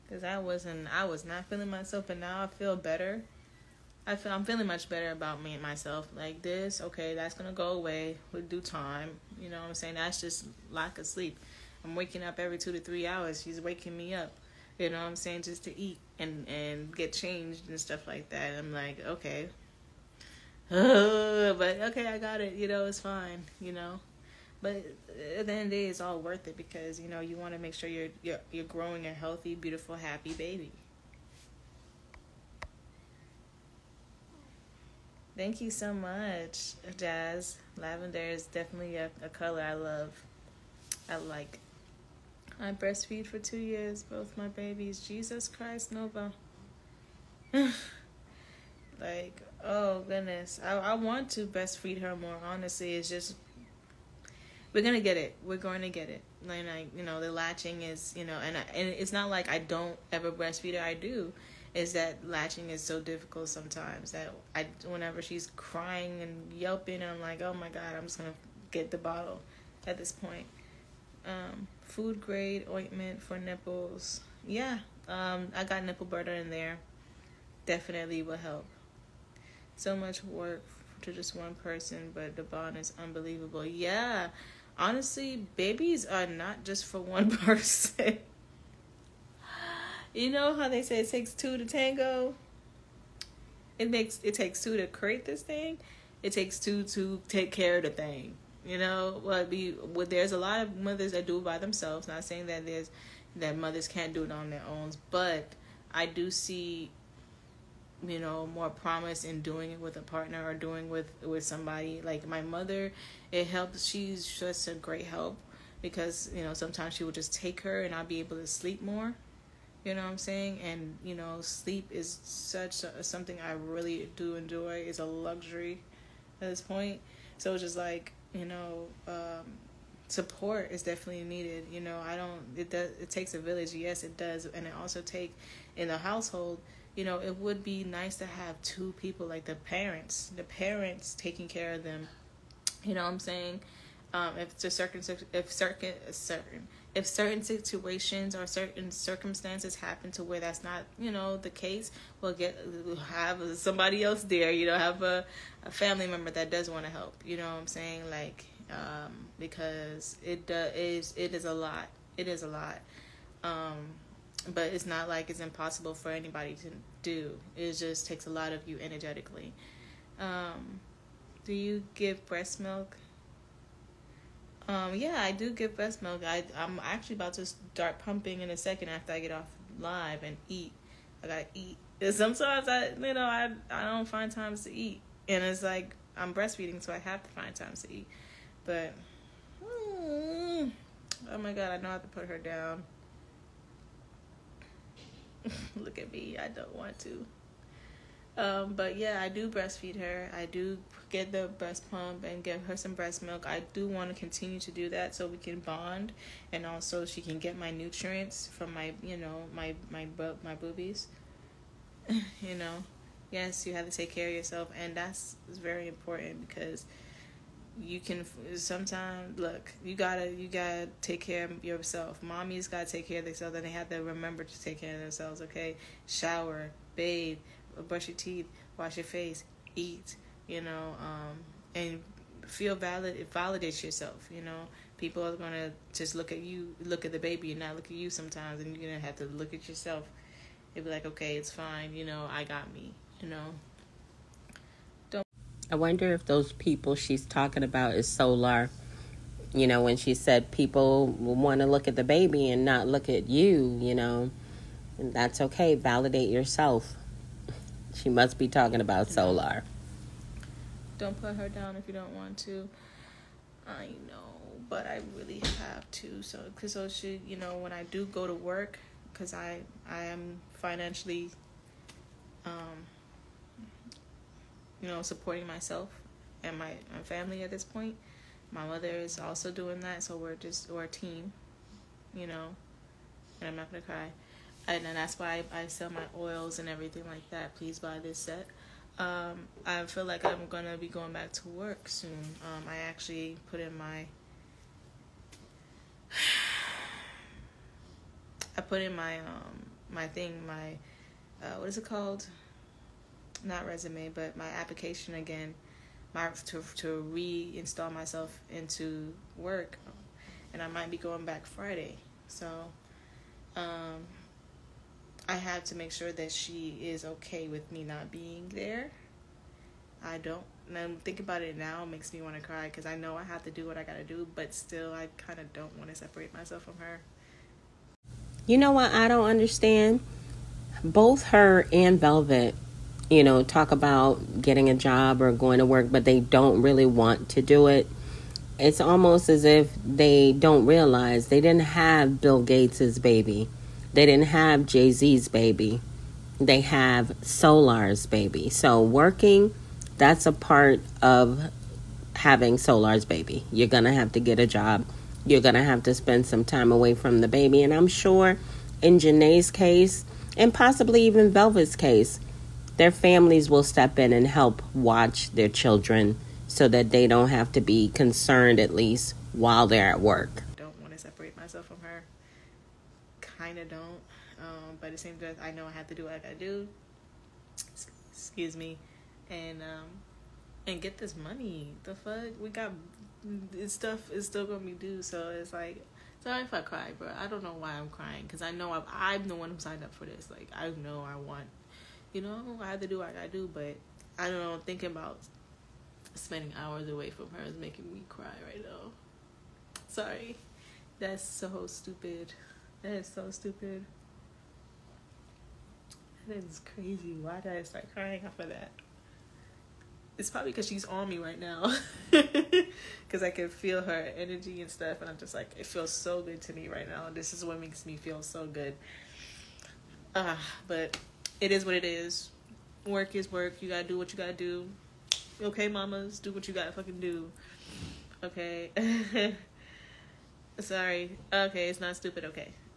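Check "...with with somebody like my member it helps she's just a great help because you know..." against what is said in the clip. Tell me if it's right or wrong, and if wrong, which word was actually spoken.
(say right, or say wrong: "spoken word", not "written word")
wrong: "mother", not "member".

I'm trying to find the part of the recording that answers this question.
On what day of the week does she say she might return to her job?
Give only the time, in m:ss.
5:11.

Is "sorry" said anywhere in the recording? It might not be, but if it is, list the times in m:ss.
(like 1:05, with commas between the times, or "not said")
6:26, 6:39, 7:10.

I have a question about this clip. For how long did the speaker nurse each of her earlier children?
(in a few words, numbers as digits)
2 years.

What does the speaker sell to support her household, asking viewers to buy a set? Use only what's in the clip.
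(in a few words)
Oils.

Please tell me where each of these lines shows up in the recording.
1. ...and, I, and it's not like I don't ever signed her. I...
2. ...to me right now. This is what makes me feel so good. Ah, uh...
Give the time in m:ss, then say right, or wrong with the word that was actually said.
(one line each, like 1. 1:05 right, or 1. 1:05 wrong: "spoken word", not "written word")
1. 0:58 wrong: "breastfeed", not "signed"
2. 6:56 right.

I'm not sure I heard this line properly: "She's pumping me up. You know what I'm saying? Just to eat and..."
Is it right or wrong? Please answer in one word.
wrong.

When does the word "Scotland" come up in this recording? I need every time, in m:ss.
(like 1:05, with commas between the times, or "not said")
not said.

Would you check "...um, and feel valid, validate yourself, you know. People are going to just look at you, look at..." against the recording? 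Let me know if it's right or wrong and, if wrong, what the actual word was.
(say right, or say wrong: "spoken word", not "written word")
right.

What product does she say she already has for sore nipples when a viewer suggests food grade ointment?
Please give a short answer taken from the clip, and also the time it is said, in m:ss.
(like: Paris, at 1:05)
Nipple butter, at 1:15.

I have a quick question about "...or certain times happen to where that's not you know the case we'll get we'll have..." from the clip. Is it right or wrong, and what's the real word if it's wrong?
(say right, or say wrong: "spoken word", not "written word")
wrong: "circumstances", not "times".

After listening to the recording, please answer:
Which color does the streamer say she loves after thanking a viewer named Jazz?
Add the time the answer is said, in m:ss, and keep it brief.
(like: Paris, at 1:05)
Lavender, at 0:37.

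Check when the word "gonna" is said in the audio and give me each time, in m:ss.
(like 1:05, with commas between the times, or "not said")
0:07, 4:43, 4:50, 6:24.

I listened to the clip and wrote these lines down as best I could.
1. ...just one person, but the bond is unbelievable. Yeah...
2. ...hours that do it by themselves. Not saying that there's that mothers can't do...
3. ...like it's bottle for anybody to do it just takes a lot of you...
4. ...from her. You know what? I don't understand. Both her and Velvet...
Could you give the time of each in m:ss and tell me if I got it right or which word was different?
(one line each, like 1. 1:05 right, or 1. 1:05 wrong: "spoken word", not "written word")
1. 1:21 right
2. 1:40 wrong: "mothers", not "hours"
3. 2:45 wrong: "impossible", not "bottle"
4. 5:26 right.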